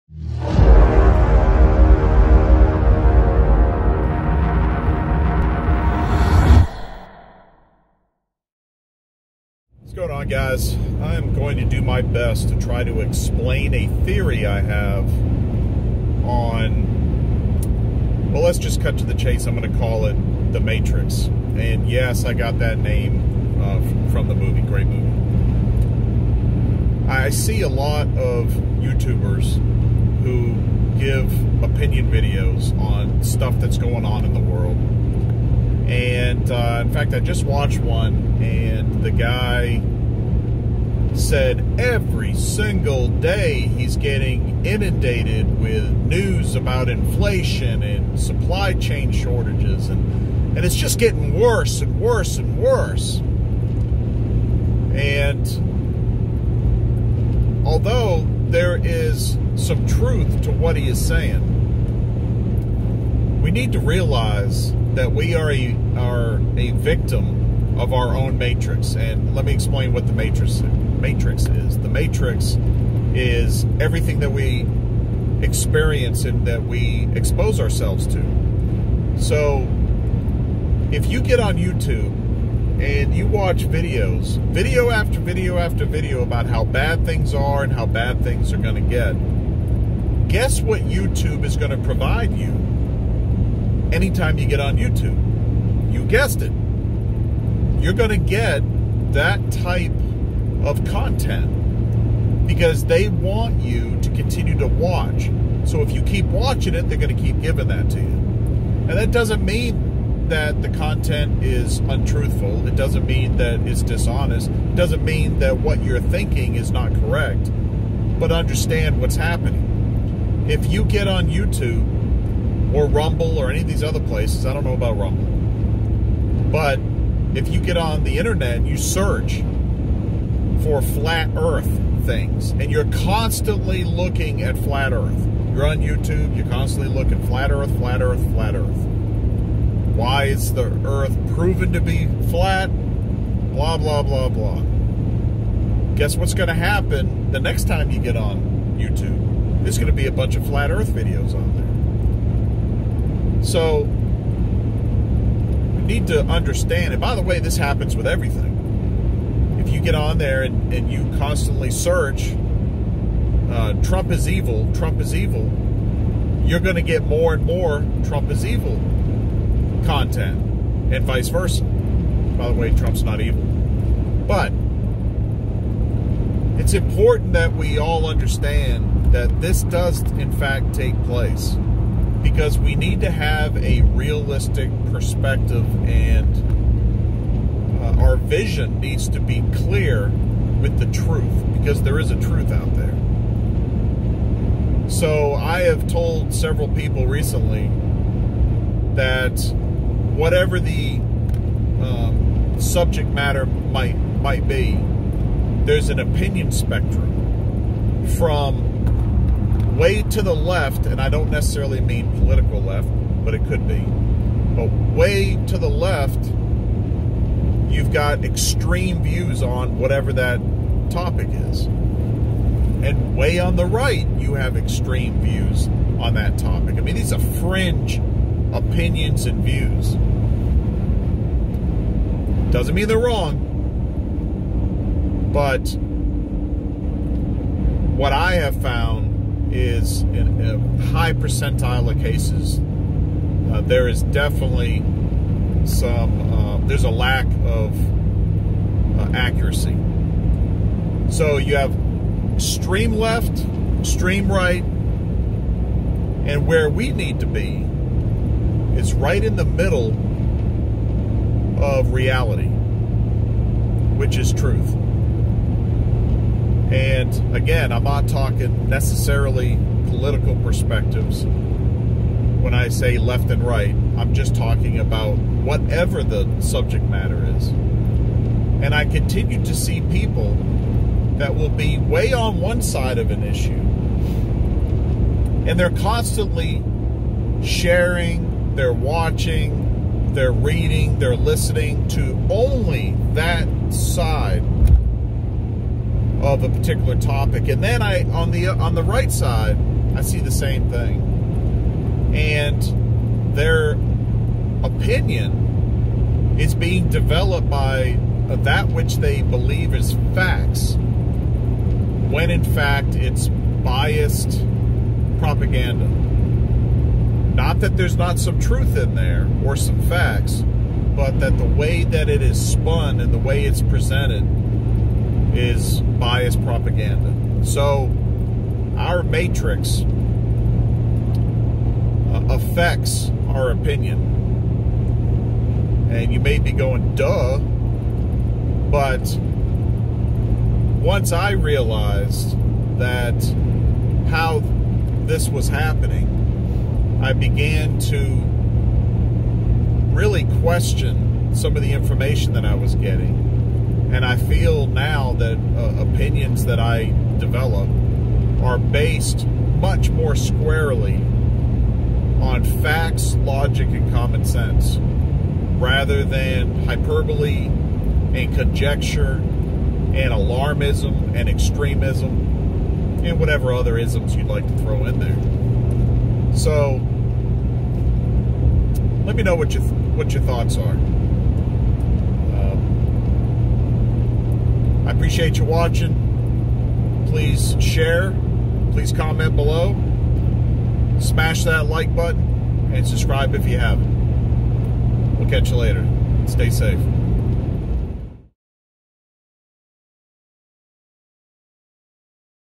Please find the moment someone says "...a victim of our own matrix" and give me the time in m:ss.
1:06.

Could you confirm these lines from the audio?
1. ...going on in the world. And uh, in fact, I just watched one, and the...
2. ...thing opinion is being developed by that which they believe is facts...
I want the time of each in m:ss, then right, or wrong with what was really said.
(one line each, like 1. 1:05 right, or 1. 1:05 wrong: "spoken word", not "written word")
1. 0:33 right
2. 5:00 right.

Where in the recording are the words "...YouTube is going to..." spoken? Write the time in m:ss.
1:30.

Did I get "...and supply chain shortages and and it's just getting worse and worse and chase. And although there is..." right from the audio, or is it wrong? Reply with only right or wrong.
wrong.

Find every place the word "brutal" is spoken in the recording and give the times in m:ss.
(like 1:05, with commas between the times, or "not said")
not said.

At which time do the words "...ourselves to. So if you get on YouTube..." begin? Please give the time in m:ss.
1:17.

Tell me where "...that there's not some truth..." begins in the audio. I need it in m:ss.
5:17.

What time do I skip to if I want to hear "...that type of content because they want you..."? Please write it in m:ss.
1:39.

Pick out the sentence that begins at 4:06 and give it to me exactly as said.
Uh, there's a lack of uh, accuracy.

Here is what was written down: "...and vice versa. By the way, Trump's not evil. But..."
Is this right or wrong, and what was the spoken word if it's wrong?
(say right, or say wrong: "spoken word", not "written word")
right.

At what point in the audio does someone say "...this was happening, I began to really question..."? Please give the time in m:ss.
5:45.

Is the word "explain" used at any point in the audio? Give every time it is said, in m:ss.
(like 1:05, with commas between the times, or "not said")
0:13, 1:09.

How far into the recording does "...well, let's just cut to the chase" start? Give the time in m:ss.
0:18.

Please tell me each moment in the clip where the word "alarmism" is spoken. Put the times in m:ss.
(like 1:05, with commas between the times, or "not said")
6:10.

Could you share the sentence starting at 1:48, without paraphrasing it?
And that doesn't mean that the content is untruthful.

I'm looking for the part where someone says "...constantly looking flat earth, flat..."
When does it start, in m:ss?
2:16.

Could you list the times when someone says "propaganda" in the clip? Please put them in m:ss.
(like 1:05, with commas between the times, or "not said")
5:15, 5:26.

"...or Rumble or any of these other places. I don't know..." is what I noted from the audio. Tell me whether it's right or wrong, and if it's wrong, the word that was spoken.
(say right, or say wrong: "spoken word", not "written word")
right.